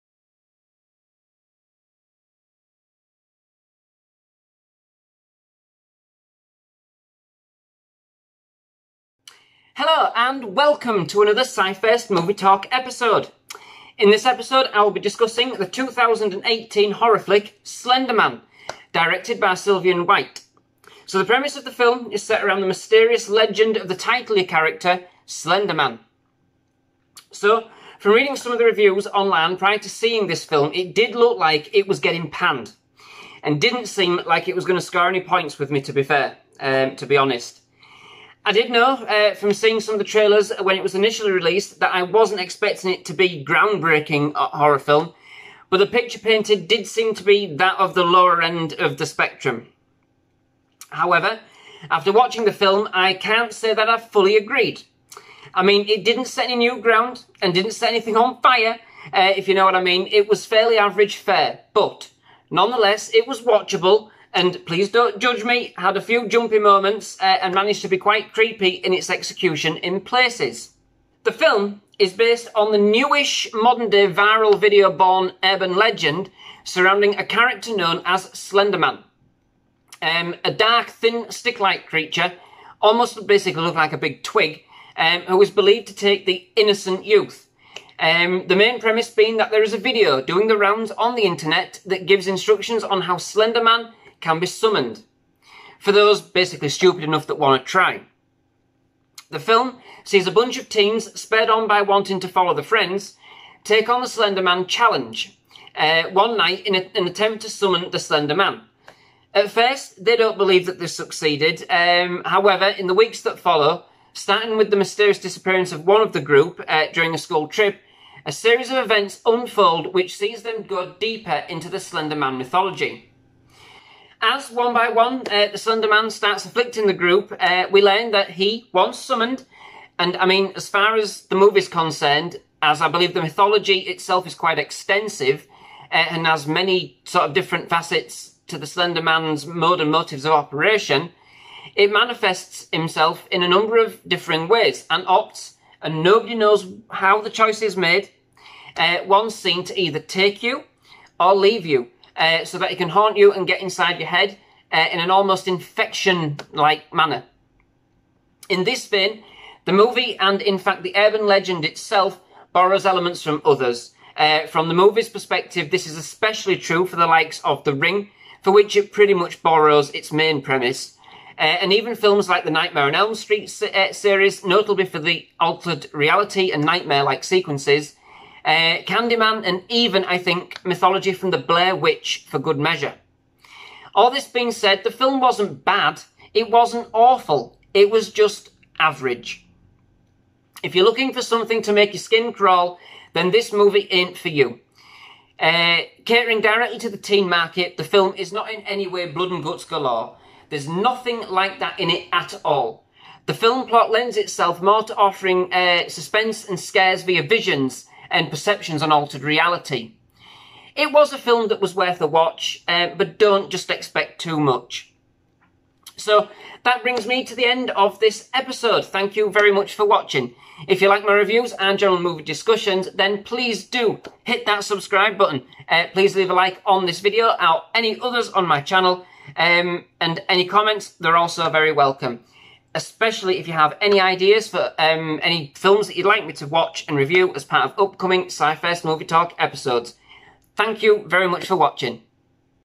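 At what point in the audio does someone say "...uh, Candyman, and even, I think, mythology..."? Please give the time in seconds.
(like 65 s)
178 s.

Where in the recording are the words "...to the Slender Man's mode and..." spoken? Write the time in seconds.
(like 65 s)
138 s.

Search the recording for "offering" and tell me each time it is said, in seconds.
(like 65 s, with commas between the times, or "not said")
204 s.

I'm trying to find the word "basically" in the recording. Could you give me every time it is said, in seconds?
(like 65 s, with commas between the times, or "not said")
83 s, 96 s.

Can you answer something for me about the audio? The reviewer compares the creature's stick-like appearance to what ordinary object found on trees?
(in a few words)
A big twig.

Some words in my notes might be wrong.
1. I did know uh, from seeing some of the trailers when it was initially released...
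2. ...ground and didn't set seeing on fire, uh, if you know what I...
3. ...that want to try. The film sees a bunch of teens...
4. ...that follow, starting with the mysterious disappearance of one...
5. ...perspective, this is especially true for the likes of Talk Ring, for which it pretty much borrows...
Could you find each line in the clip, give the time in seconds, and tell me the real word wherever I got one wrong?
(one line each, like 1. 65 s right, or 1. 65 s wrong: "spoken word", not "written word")
1. 38 s right
2. 56 s wrong: "anything", not "seeing"
3. 97 s right
4. 113 s right
5. 165 s wrong: "The", not "Talk".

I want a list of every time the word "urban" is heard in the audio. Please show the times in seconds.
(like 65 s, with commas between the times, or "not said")
75 s, 160 s.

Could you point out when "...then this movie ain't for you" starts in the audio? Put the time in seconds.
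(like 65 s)
193 s.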